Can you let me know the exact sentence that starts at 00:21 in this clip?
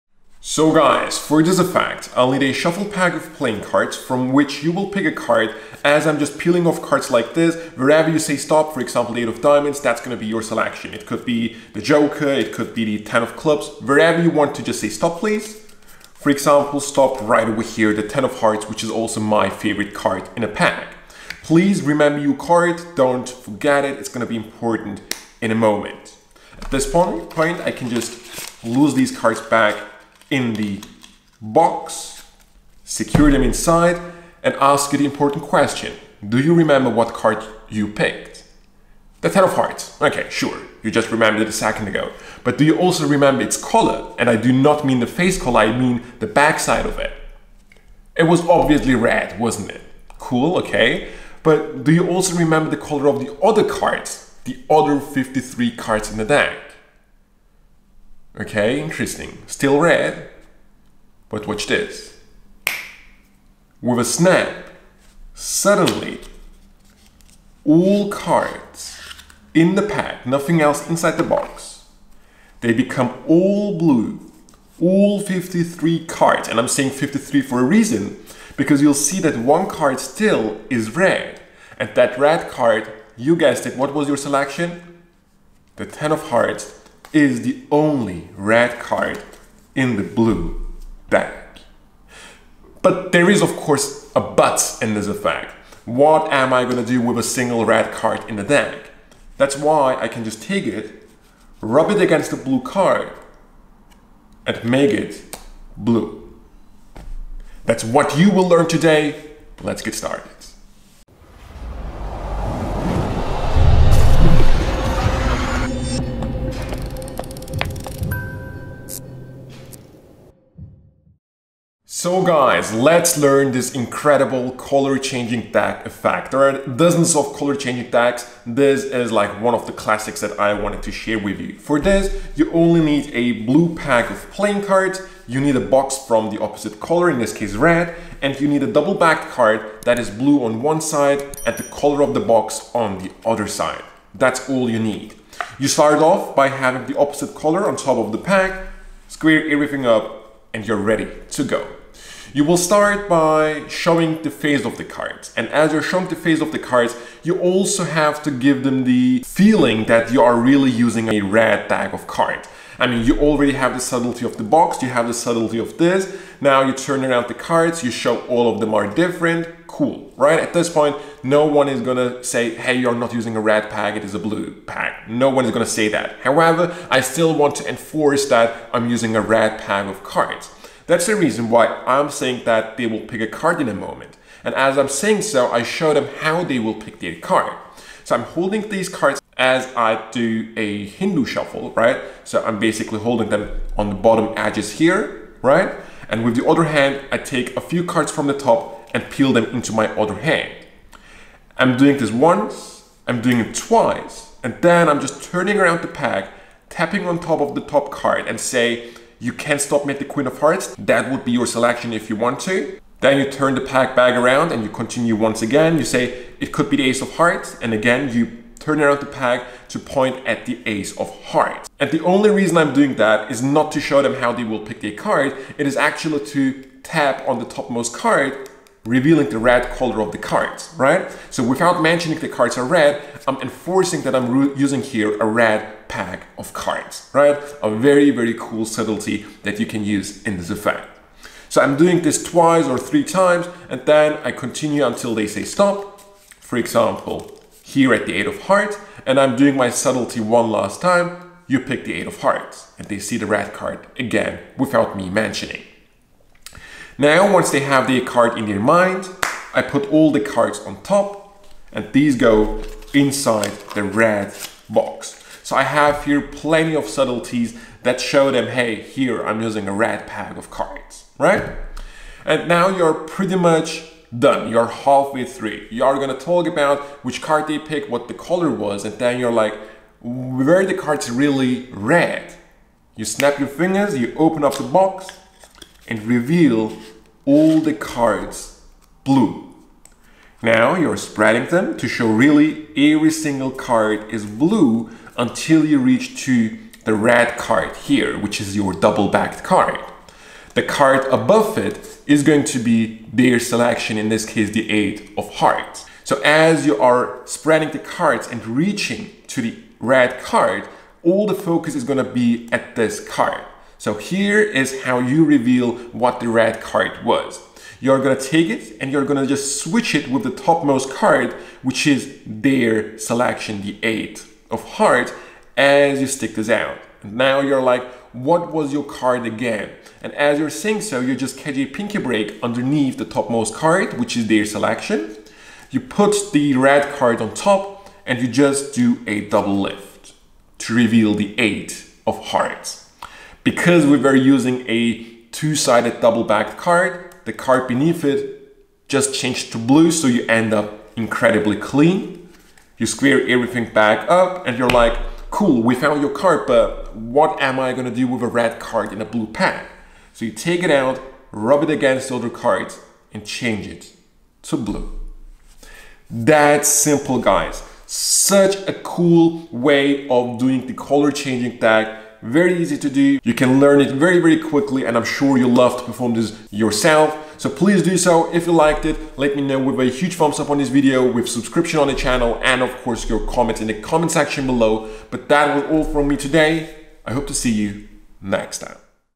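Please remember your card, don't forget it, it's going to be important in a moment.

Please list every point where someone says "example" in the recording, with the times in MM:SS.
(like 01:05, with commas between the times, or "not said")
00:08, 00:16, 04:06.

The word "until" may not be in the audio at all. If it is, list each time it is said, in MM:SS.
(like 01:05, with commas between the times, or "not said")
04:04, 04:55.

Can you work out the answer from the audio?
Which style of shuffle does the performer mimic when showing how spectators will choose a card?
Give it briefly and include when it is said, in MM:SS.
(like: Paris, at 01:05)
Hindu shuffle, at 03:10.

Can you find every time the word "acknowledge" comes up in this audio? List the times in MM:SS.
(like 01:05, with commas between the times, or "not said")
not said.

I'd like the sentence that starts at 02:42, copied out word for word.
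I mean, you already have the subtlety of the box, you have the subtlety of this.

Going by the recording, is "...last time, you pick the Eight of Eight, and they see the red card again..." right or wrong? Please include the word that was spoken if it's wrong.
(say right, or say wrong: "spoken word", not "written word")
wrong: "Hearts", not "Eight".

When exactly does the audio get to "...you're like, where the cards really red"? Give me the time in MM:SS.
04:39.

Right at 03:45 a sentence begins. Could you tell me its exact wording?
It is actually to tap on the topmost card revealing the red color of the cards, right?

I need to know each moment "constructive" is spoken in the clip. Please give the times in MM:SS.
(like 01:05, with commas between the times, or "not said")
not said.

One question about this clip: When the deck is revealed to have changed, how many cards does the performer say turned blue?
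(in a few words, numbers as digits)
53.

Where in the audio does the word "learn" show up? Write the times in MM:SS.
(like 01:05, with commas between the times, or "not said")
01:48, 02:03, 06:13.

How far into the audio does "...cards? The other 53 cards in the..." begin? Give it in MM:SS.
00:53.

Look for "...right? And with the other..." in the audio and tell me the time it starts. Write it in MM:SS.
03:15.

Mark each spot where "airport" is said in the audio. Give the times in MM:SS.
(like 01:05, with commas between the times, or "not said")
not said.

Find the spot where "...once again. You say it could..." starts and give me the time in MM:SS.
03:35.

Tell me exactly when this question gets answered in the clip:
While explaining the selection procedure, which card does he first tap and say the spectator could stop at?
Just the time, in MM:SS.
03:30.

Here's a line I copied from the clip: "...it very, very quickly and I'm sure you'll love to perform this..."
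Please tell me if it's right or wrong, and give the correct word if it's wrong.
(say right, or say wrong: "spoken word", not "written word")
right.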